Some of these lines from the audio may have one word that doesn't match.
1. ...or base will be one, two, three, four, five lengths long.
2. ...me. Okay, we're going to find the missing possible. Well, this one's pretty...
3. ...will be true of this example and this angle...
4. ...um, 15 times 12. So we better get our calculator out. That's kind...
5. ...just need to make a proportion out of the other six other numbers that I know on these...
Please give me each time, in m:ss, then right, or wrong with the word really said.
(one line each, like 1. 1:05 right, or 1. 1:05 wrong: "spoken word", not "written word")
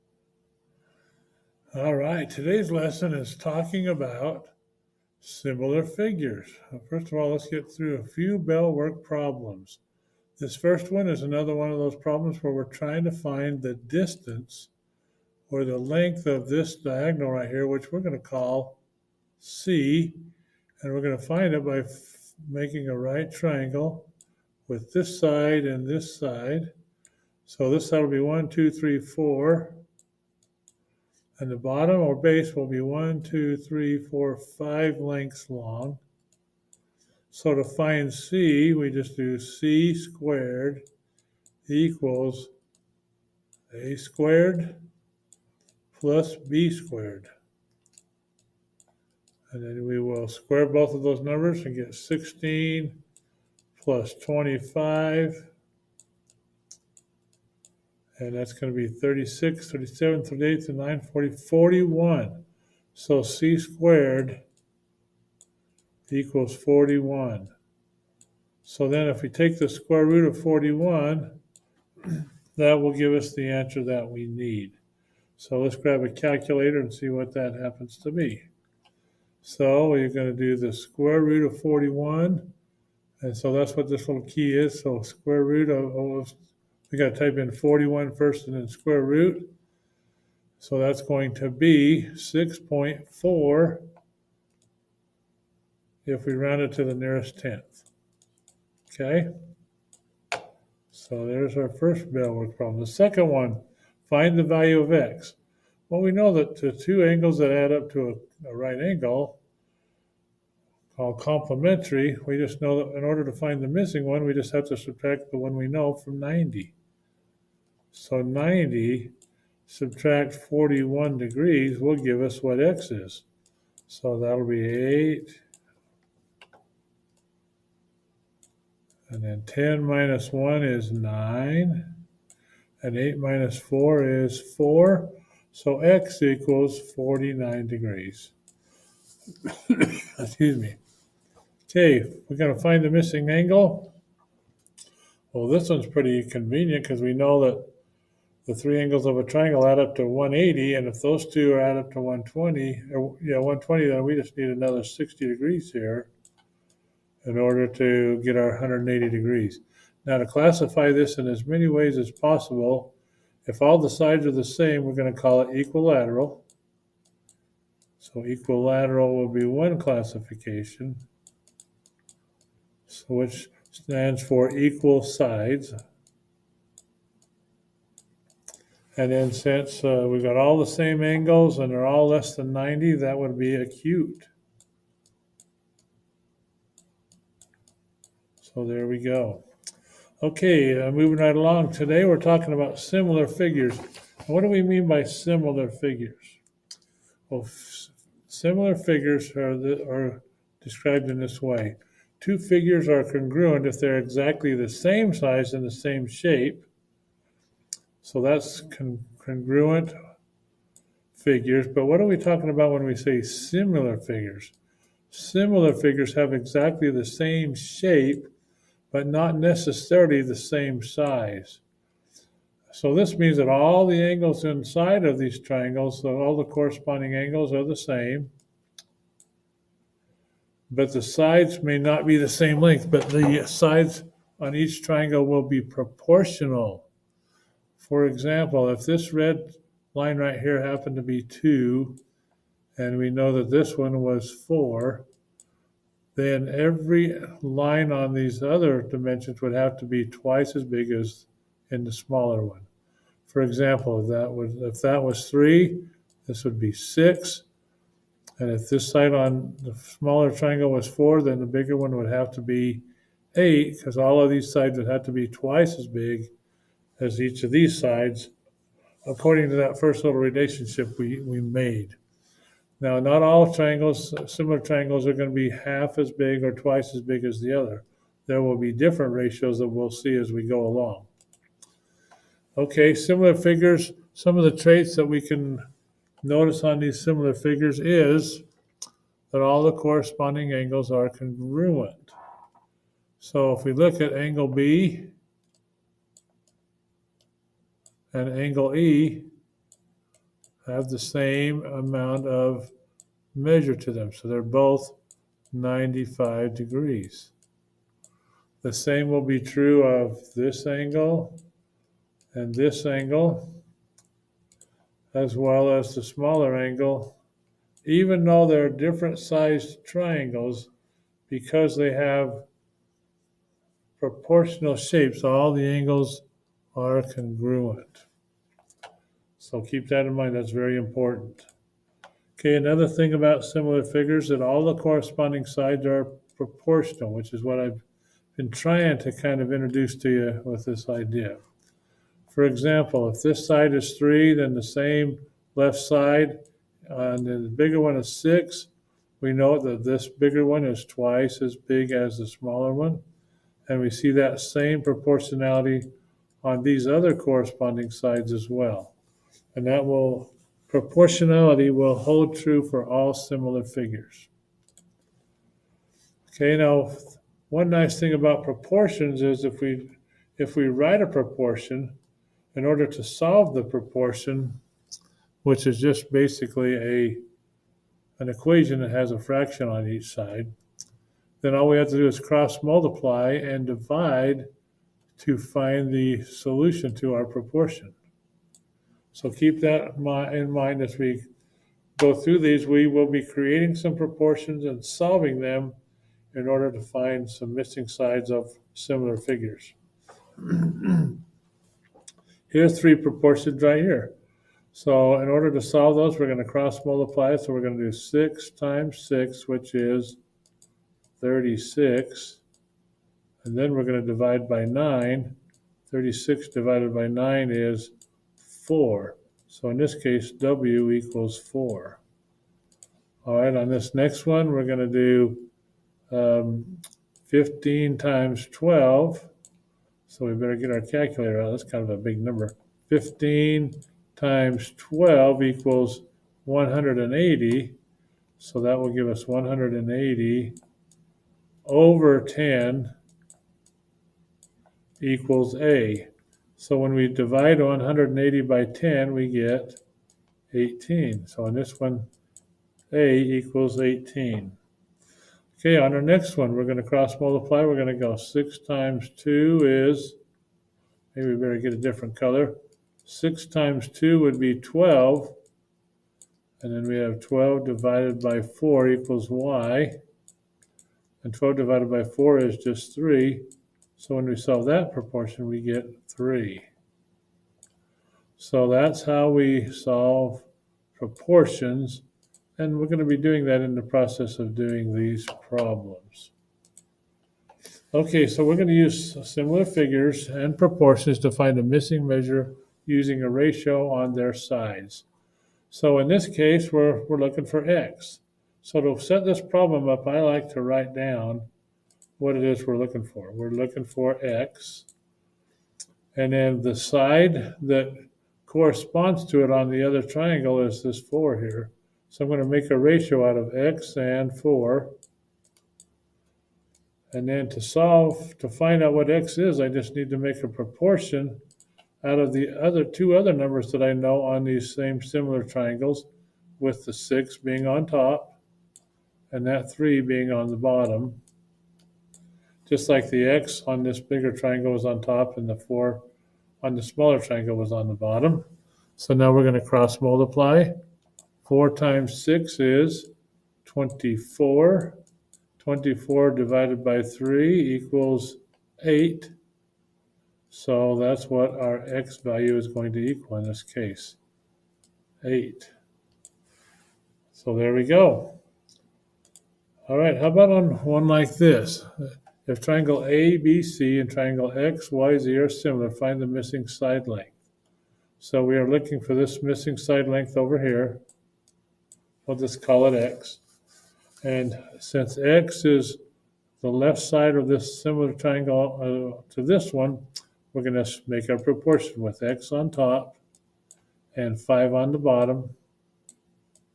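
1. 0:32 right
2. 2:20 wrong: "angle", not "possible"
3. 5:09 wrong: "angle", not "example"
4. 7:06 right
5. 8:39 wrong: "two", not "six".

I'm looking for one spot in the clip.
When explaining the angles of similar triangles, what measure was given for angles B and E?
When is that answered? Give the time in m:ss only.
5:05.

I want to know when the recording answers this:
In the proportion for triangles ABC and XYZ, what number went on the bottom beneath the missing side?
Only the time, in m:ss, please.
9:44.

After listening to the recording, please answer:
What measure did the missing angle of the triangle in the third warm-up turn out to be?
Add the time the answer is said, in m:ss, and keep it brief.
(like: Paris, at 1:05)
60 degrees, at 2:34.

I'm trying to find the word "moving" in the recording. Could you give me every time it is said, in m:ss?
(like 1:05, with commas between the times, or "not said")
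3:10.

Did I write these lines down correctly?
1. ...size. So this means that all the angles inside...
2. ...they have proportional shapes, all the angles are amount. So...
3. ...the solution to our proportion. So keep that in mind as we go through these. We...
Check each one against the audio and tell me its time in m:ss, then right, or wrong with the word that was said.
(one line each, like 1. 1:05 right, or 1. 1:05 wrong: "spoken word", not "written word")
1. 3:40 right
2. 5:21 wrong: "congruent", not "amount"
3. 6:25 right.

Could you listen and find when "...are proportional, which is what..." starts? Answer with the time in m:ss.
5:35.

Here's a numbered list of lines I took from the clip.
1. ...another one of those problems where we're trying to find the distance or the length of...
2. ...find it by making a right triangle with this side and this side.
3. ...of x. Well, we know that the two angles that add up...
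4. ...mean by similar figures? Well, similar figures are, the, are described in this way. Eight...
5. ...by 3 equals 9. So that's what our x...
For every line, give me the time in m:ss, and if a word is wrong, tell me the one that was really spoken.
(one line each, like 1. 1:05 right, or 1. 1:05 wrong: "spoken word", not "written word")
1. 0:11 right
2. 0:21 right
3. 1:44 right
4. 3:14 wrong: "Two", not "Eight"
5. 9:06 wrong: "8", not "9".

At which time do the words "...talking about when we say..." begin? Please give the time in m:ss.
3:32.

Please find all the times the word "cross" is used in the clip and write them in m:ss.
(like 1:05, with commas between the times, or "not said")
6:22, 6:46, 7:36, 8:59.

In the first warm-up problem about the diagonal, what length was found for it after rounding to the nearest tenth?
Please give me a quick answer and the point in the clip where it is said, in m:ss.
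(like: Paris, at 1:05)
6.4, at 1:32.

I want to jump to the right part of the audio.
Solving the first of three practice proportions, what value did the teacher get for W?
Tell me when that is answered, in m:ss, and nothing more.
7:00.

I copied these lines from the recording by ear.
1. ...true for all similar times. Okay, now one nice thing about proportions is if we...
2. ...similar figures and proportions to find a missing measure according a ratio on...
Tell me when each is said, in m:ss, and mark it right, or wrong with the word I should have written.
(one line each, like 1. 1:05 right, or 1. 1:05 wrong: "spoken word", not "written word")
1. 6:02 wrong: "figures", not "times"
2. 8:09 wrong: "using", not "according".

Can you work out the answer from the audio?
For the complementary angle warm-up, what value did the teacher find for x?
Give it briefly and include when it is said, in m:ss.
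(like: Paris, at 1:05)
49 degrees, at 2:16.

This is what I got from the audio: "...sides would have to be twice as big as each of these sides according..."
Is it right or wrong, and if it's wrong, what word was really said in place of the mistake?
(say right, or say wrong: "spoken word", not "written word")
right.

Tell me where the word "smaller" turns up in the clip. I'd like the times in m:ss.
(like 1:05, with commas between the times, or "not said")
4:11, 4:19, 5:16, 5:52, 8:56.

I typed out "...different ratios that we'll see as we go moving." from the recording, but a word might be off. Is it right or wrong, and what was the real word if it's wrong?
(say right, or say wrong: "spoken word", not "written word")
wrong: "along", not "moving".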